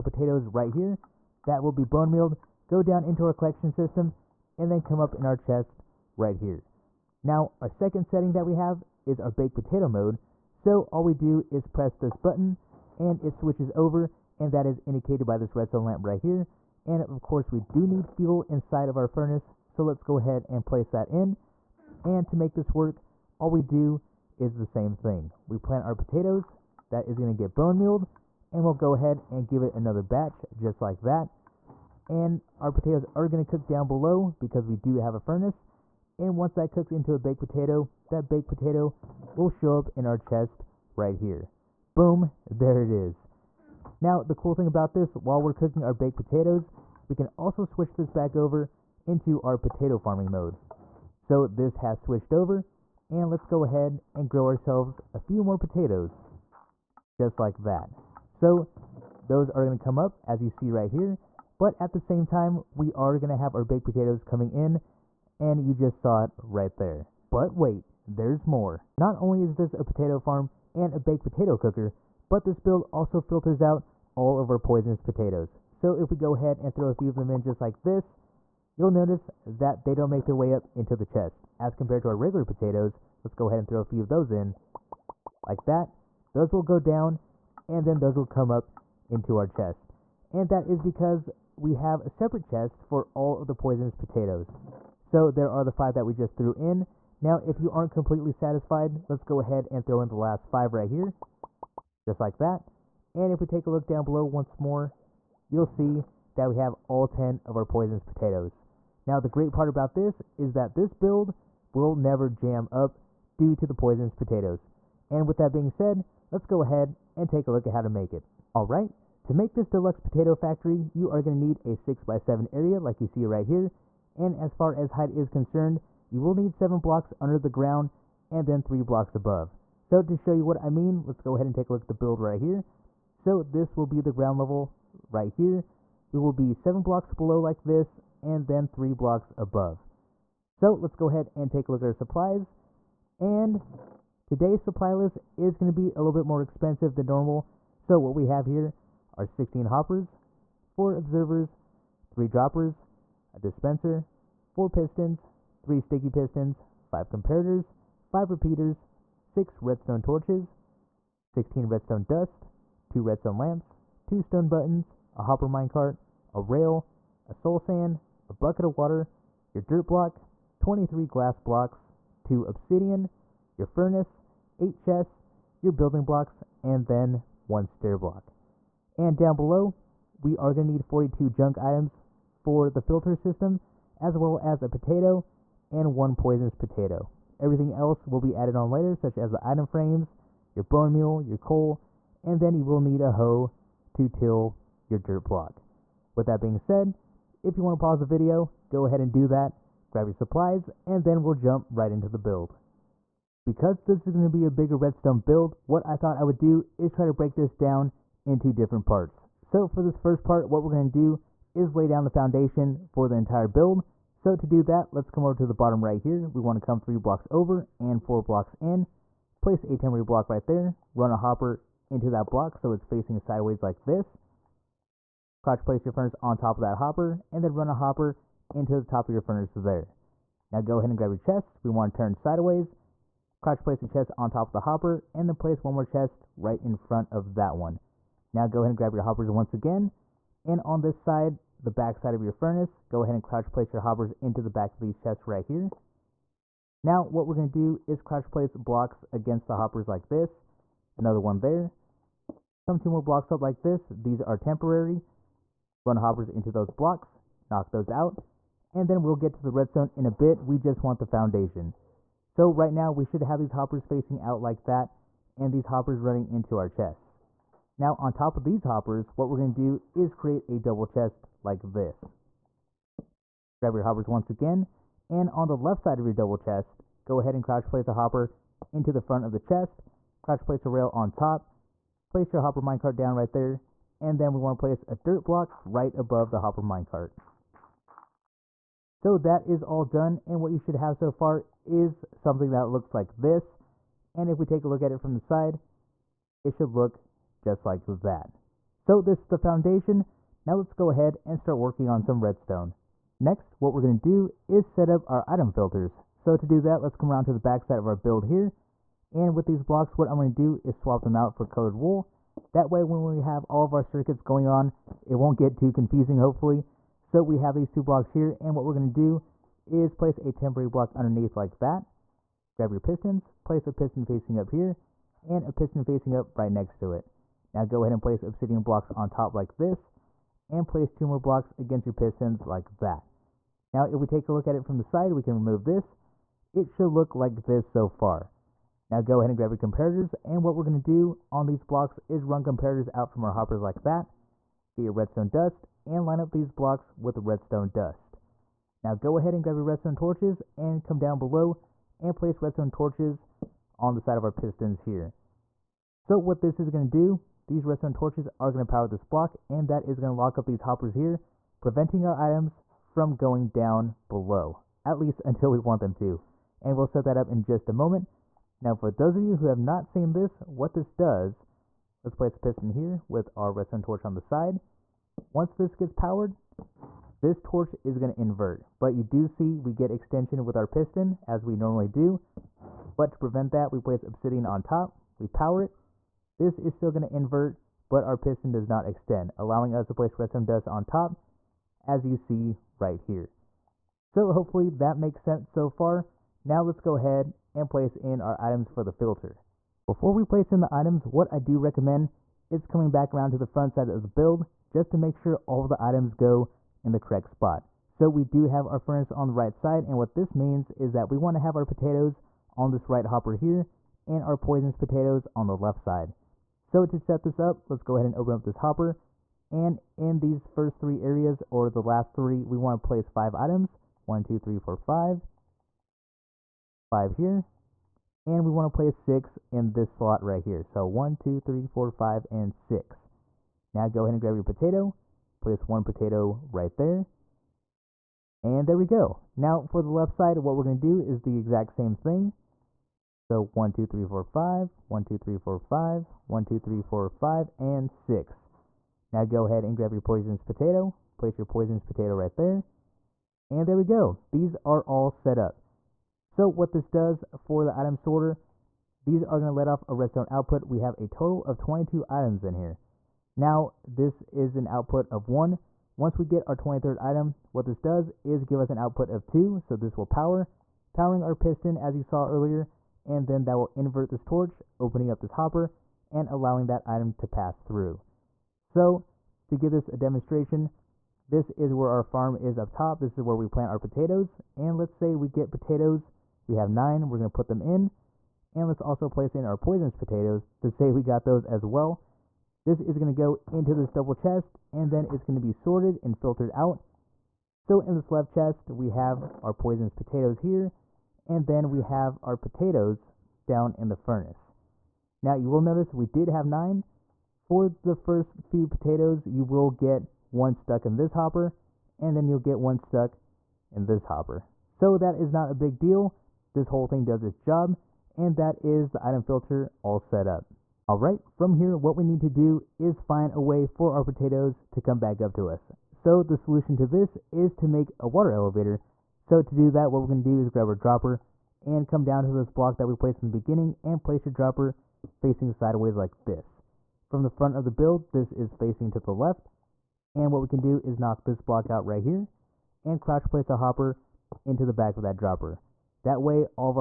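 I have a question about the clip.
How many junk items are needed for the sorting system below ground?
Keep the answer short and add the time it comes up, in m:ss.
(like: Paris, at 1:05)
42, at 3:00.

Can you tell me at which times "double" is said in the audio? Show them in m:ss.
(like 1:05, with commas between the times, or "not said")
4:30, 4:36, 8:13.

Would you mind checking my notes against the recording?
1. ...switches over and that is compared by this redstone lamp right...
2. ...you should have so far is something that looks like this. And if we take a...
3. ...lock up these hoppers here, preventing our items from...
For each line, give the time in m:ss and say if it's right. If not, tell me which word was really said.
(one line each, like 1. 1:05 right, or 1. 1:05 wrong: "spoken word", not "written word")
1. 0:13 wrong: "indicated", not "compared"
2. 4:50 right
3. 6:00 right.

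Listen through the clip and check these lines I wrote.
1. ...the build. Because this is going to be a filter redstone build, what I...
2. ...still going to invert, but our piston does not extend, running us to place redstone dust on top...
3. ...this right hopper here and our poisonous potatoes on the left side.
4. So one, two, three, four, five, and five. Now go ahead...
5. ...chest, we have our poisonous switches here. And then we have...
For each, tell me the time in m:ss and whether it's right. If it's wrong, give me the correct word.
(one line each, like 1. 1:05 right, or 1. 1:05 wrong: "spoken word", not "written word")
1. 3:22 wrong: "bigger", not "filter"
2. 6:26 wrong: "allowing", not "running"
3. 6:52 right
4. 7:10 wrong: "six", not "five"
5. 8:18 wrong: "potatoes", not "switches".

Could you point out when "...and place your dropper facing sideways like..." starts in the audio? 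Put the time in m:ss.
8:53.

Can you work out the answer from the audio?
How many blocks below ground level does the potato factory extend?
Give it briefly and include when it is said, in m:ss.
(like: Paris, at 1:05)
7, at 2:06.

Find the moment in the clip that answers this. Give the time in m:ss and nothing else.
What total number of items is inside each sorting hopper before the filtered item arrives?
7:41.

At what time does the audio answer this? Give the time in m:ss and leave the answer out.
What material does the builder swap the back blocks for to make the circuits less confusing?
5:11.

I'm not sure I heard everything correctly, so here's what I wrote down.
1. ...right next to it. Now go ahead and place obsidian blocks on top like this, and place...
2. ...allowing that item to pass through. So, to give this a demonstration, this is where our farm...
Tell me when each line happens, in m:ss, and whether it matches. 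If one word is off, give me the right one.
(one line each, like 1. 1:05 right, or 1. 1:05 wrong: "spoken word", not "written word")
1. 5:26 right
2. 7:56 right.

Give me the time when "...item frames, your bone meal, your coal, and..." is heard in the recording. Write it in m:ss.
3:09.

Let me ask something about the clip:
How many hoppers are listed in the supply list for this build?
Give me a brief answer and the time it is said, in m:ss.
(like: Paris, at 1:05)
16, at 2:29.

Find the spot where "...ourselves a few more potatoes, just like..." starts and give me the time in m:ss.
0:54.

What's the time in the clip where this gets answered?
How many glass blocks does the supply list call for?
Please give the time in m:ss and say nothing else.
2:50.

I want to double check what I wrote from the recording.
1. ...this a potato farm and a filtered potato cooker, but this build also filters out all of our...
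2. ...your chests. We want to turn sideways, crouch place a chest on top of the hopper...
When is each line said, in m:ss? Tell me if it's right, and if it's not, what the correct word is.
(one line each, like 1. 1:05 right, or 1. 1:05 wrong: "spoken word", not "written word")
1. 1:09 wrong: "baked", not "filtered"
2. 3:51 right.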